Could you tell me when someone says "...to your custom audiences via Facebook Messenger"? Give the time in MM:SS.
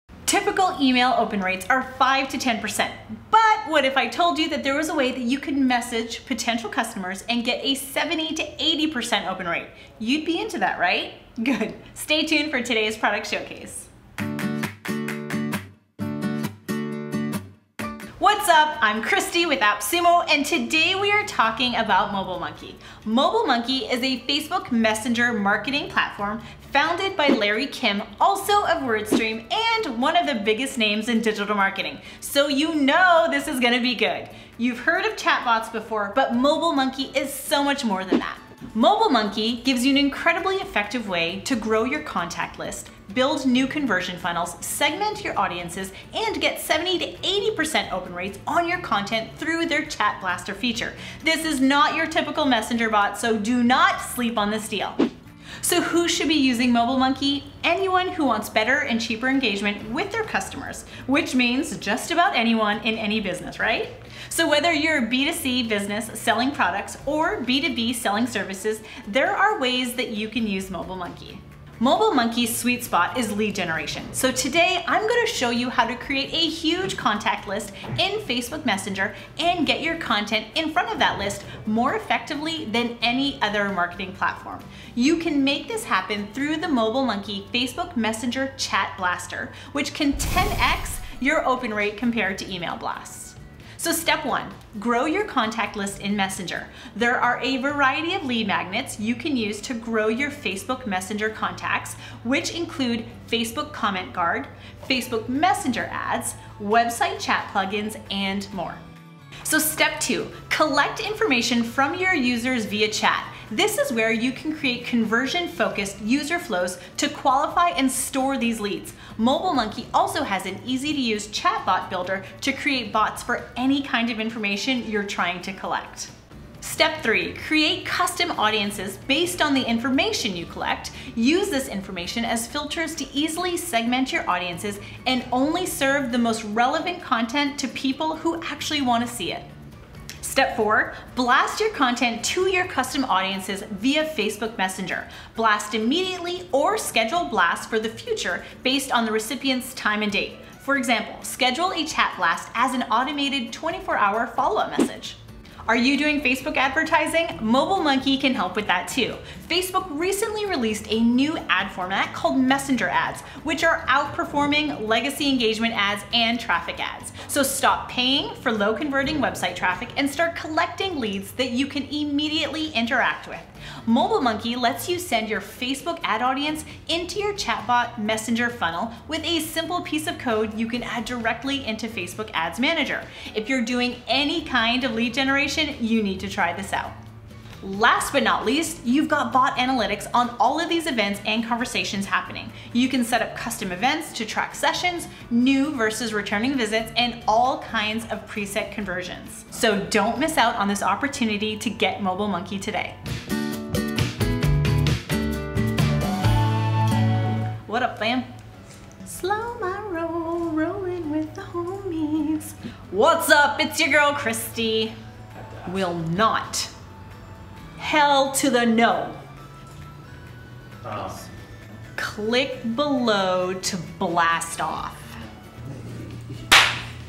02:22.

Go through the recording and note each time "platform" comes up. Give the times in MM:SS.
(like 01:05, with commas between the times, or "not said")
00:25, 01:24.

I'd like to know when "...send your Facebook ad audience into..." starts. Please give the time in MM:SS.
02:54.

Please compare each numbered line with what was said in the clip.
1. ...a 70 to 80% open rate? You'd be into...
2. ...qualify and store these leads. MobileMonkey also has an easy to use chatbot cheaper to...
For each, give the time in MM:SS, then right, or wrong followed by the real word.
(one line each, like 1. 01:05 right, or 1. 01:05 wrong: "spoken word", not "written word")
1. 00:07 right
2. 01:57 wrong: "builder", not "cheaper".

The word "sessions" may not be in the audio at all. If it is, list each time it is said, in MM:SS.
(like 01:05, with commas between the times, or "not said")
03:14.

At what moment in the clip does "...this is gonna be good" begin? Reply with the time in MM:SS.
00:33.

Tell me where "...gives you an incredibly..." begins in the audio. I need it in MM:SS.
00:39.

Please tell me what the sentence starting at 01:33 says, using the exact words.
So step one, grow your contact list in Messenger.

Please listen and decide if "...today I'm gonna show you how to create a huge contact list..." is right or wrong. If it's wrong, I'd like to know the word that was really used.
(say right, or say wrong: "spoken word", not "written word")
right.